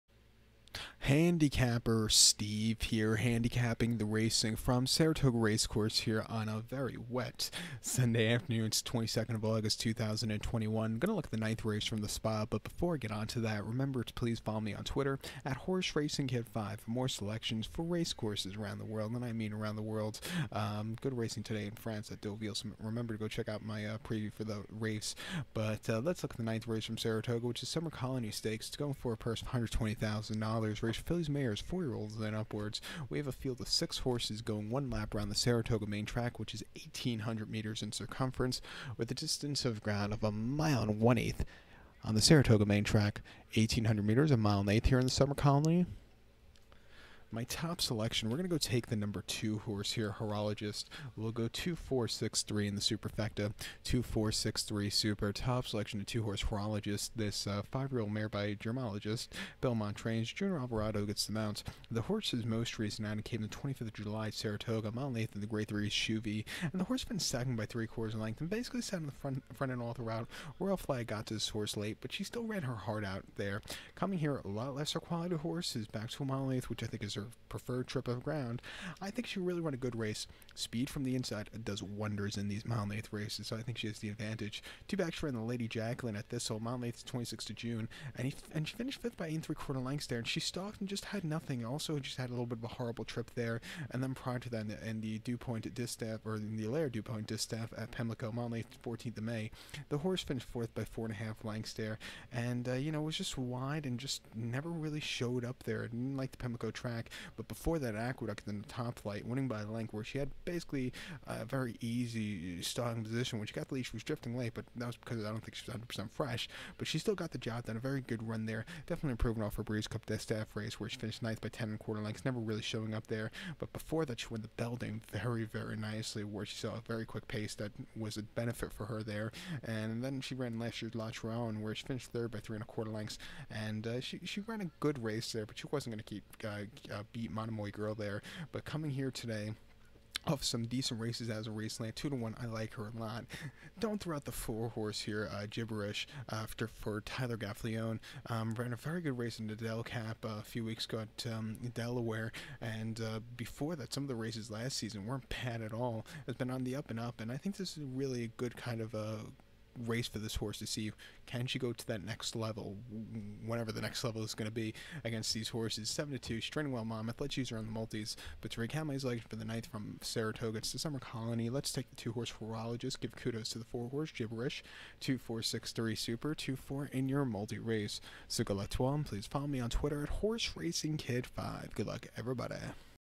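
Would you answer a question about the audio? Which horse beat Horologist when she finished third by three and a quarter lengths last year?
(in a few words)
Monomoy Girl.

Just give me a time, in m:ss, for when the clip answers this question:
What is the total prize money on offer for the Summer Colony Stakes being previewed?
0:29.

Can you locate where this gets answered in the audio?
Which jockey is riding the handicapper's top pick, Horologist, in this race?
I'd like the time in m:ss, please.
1:00.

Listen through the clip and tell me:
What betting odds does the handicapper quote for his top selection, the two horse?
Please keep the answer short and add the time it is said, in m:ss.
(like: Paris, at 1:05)
2 to 1, at 2:21.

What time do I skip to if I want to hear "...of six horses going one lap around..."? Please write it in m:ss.
0:33.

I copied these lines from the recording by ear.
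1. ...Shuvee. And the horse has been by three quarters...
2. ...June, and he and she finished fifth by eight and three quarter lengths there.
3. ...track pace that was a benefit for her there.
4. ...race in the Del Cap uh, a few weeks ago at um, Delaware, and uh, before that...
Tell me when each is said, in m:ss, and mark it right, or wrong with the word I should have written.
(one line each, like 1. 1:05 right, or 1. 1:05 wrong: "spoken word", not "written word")
1. 1:05 right
2. 1:27 right
3. 2:07 wrong: "quick", not "track"
4. 2:29 right.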